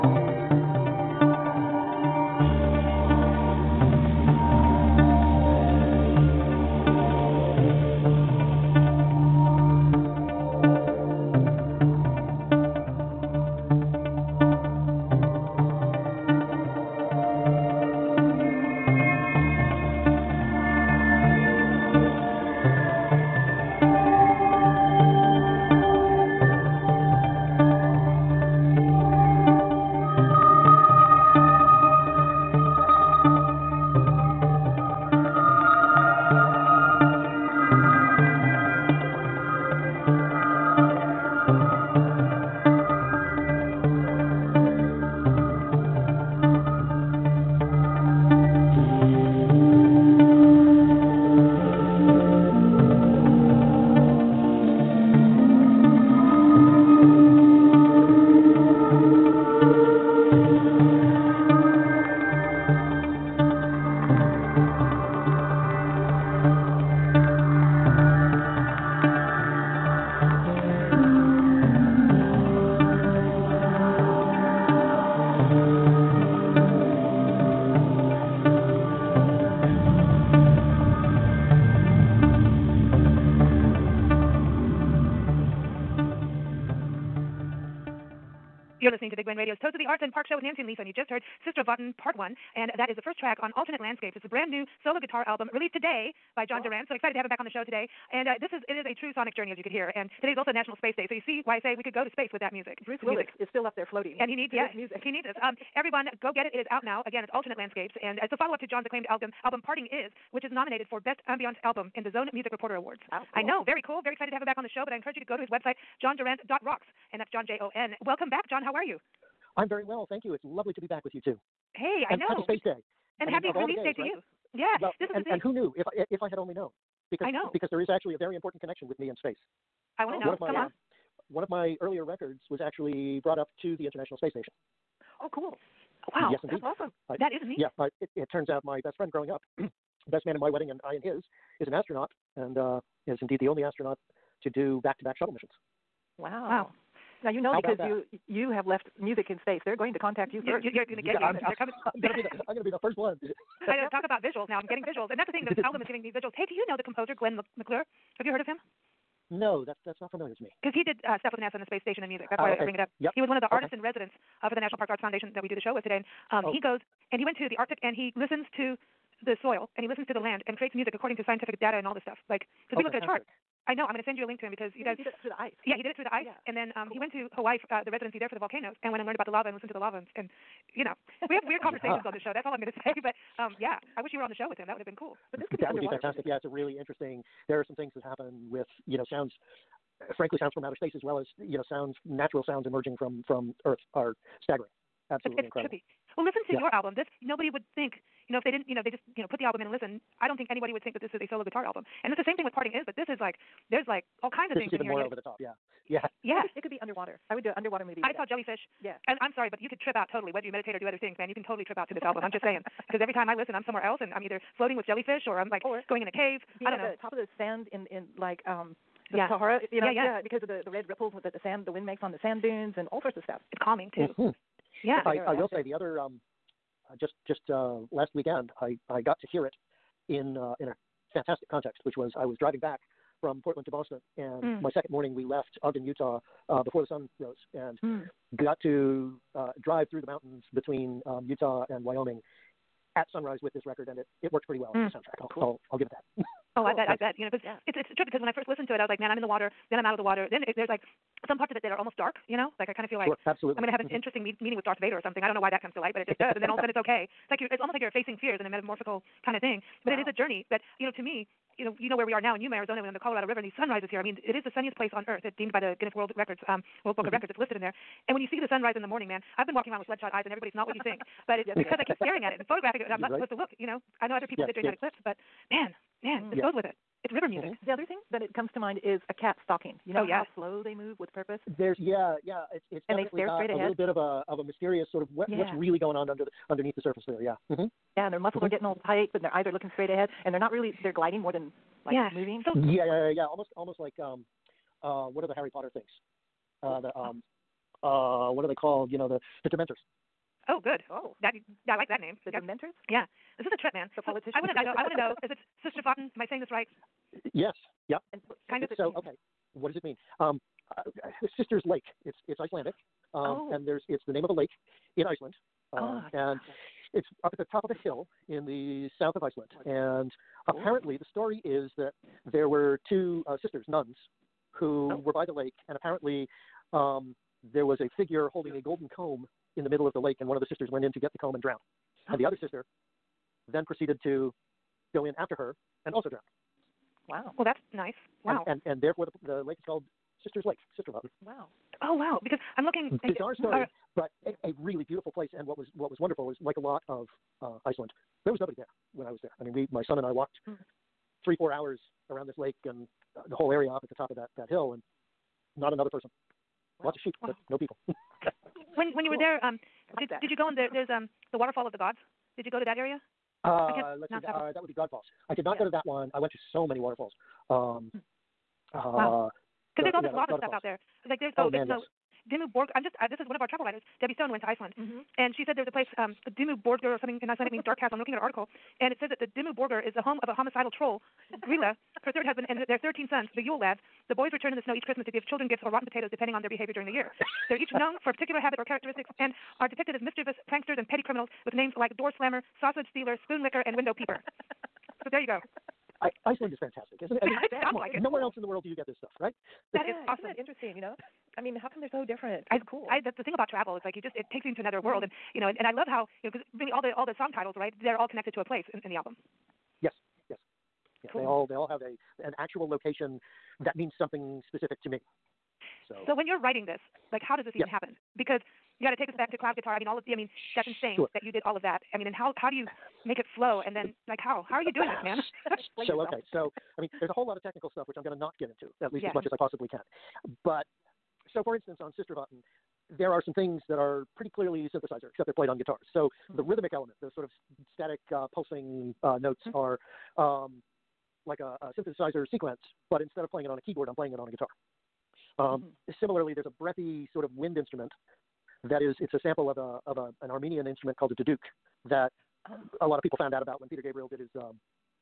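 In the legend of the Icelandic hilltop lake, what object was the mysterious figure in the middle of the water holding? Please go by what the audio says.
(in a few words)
golden comb.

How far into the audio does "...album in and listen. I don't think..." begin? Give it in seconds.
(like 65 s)
199 s.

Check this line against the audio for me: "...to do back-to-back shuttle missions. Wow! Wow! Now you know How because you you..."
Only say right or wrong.
right.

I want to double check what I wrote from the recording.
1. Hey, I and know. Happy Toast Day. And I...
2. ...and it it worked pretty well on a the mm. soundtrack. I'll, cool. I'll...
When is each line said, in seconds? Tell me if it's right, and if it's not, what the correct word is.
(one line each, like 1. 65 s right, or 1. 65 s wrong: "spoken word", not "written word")
1. 121 s wrong: "Space", not "Toast"
2. 243 s right.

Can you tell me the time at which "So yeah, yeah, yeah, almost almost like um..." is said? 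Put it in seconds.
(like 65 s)
292 s.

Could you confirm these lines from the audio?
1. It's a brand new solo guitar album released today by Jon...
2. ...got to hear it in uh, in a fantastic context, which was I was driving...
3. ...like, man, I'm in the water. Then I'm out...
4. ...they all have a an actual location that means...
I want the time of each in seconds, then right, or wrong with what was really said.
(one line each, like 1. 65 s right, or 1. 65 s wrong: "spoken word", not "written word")
1. 94 s right
2. 229 s right
3. 248 s right
4. 411 s right.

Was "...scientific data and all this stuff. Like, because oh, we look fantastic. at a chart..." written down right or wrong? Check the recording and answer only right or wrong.
right.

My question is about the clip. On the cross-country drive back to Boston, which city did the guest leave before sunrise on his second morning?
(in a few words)
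Ogden, Utah.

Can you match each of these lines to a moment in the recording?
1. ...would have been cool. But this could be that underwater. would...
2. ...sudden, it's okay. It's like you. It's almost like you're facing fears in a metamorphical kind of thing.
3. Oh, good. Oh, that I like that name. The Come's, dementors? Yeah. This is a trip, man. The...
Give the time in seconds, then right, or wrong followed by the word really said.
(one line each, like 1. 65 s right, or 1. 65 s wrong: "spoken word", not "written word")
1. 184 s right
2. 256 s right
3. 300 s wrong: "That", not "Come".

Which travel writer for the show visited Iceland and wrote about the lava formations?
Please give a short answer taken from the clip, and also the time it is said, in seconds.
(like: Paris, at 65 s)
Debbie Stone, at 374 s.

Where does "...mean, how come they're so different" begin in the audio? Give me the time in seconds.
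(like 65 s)
401 s.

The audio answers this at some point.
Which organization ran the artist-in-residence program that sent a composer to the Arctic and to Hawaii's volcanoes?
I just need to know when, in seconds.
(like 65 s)
164 s.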